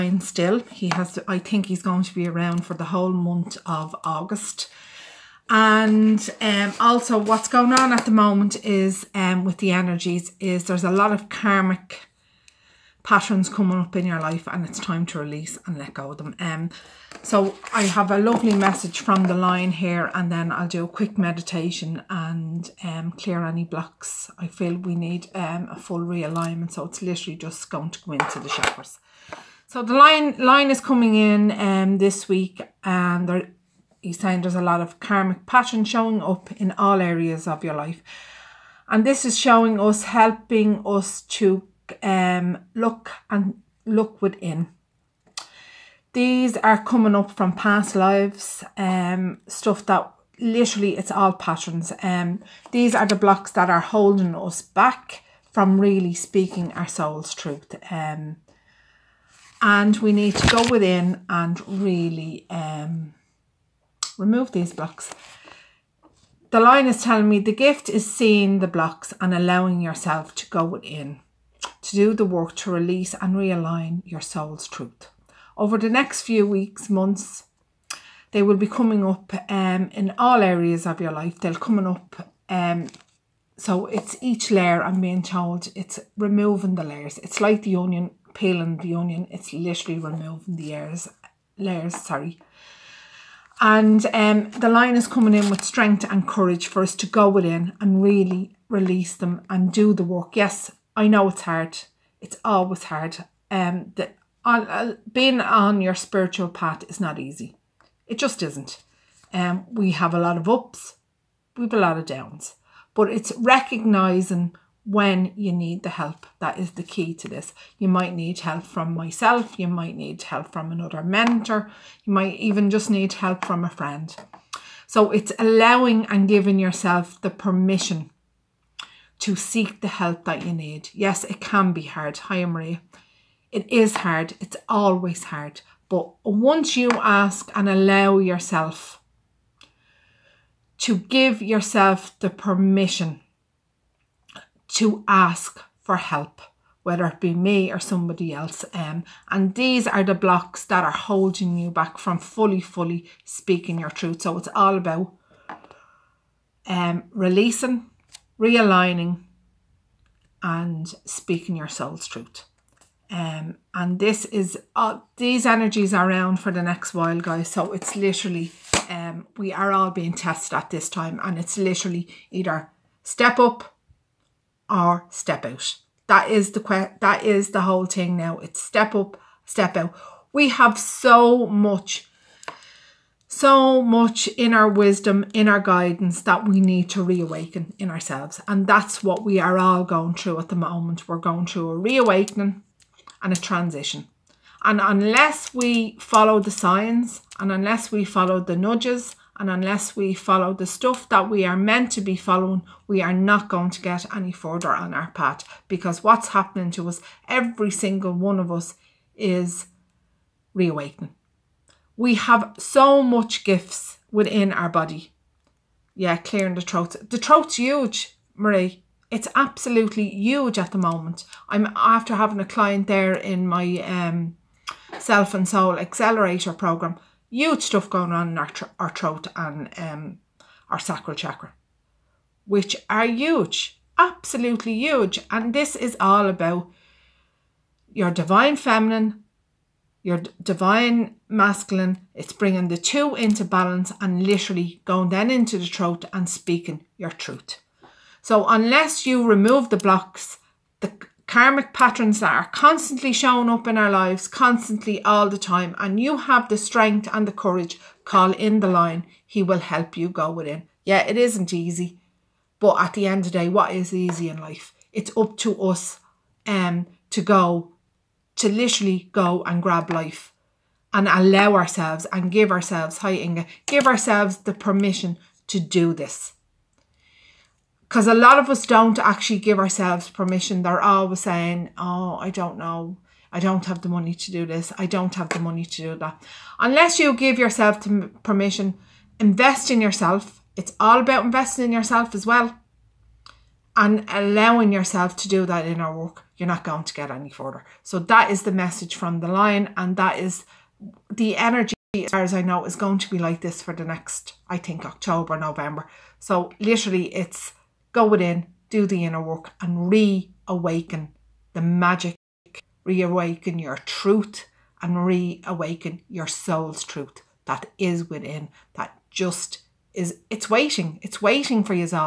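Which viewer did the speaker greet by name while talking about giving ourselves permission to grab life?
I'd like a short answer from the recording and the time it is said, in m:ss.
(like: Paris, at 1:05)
Inga, at 4:33.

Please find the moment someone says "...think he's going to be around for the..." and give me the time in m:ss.
0:01.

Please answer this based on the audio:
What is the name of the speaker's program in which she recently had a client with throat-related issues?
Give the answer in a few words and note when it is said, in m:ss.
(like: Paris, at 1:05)
Self and soul accelerator, at 3:44.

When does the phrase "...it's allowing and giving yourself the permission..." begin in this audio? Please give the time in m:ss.
2:05.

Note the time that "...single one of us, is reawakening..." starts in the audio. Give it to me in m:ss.
3:27.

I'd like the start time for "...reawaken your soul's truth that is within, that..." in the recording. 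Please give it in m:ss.
5:15.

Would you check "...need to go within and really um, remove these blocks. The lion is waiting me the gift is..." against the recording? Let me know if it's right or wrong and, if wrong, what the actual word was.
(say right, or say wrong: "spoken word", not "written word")
wrong: "telling", not "waiting".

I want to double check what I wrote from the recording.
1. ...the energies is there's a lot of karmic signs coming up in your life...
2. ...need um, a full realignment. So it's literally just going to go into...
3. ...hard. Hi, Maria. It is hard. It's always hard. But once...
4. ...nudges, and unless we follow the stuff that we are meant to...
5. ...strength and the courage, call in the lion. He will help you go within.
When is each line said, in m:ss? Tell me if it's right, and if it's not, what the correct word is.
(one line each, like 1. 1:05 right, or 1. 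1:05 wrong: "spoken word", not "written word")
1. 0:09 wrong: "patterns", not "signs"
2. 0:24 right
3. 2:11 right
4. 3:18 right
5. 4:16 right.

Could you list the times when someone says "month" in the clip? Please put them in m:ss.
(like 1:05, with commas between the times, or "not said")
0:03, 1:16.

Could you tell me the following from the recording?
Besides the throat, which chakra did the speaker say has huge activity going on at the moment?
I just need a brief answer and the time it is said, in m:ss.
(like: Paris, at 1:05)
Sacral chakra, at 3:50.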